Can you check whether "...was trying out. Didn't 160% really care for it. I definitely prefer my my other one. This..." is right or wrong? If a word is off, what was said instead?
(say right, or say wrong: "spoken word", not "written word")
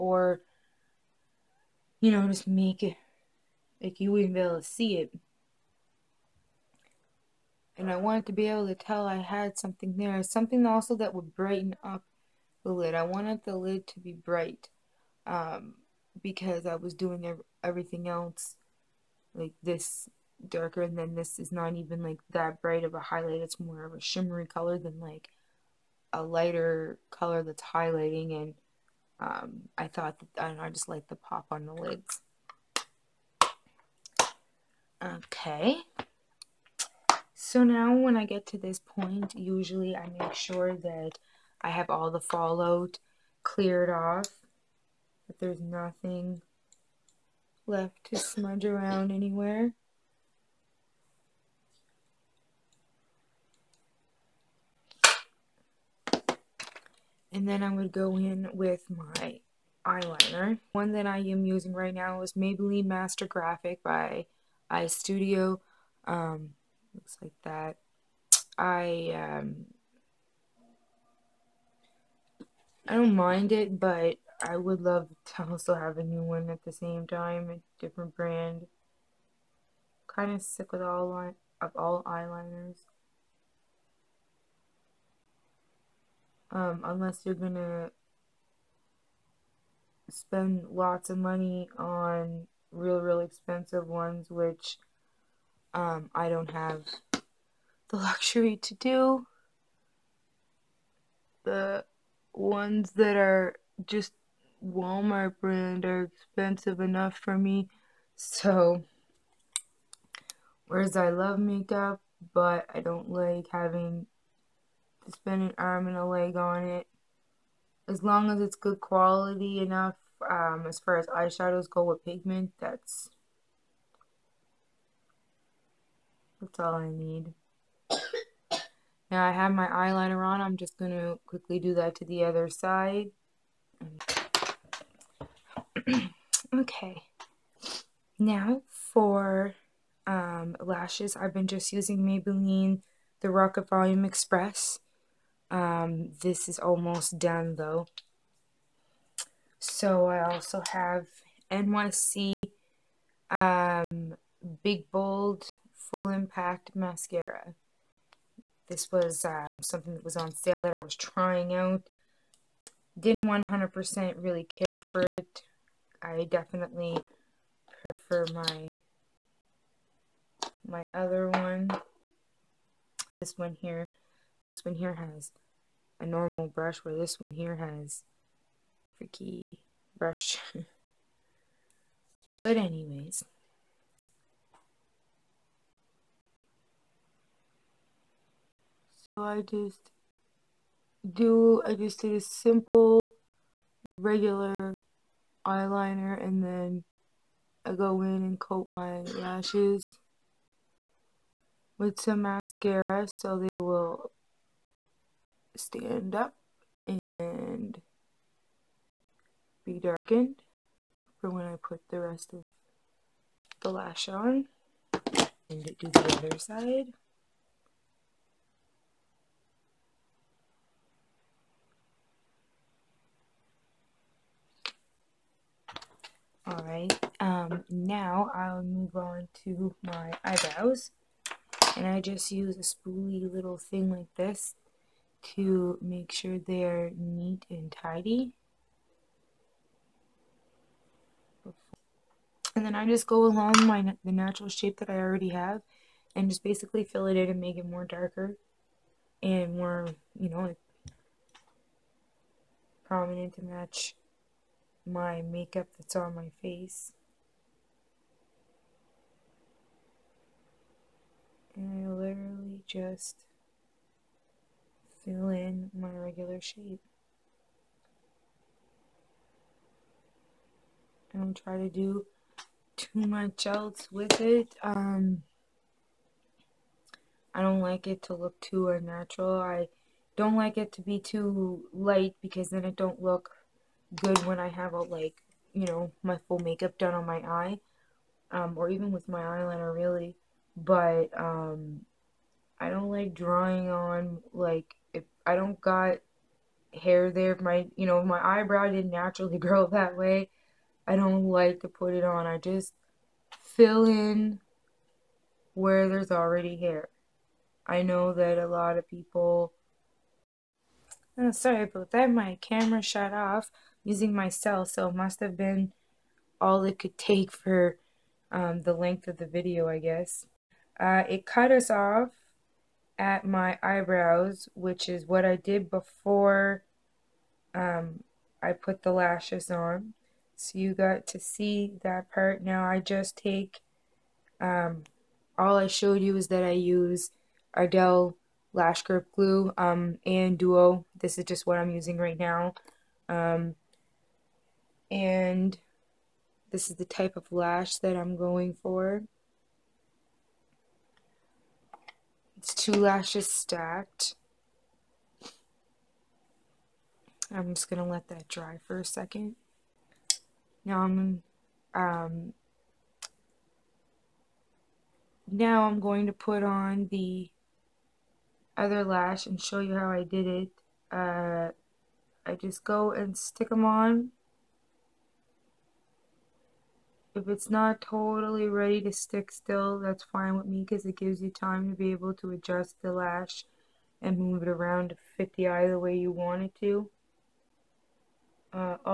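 wrong: "100", not "160".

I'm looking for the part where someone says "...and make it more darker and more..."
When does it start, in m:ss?
4:07.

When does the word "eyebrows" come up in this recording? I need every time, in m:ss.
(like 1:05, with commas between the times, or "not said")
3:50, 4:58, 5:23.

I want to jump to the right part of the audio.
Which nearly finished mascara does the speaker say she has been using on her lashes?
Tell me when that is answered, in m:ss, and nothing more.
2:23.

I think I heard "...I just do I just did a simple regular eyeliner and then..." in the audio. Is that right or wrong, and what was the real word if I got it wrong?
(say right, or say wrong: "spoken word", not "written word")
right.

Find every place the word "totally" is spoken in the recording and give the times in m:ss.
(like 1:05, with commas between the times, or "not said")
6:17.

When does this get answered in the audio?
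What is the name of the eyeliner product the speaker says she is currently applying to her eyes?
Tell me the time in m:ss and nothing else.
1:02.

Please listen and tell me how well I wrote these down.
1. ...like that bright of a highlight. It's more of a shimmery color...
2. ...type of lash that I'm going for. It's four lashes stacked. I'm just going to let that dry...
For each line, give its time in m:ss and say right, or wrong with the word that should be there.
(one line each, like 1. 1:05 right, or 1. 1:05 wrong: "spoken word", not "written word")
1. 0:22 right
2. 5:46 wrong: "two", not "four".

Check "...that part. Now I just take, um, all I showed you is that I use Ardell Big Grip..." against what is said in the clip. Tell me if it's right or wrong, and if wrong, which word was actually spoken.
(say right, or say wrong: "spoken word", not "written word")
wrong: "Lash", not "Big".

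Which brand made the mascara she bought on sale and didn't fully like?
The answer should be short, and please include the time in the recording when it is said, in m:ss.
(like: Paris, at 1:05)
NYC, at 2:31.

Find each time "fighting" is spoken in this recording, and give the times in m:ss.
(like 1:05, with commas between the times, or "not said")
not said.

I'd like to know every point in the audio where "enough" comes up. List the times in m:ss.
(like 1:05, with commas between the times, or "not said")
1:46, 1:59.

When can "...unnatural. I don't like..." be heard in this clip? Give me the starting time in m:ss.
4:38.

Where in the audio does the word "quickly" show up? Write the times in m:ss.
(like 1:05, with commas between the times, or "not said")
2:11.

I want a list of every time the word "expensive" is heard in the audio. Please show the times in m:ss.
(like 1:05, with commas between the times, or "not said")
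1:33, 1:46.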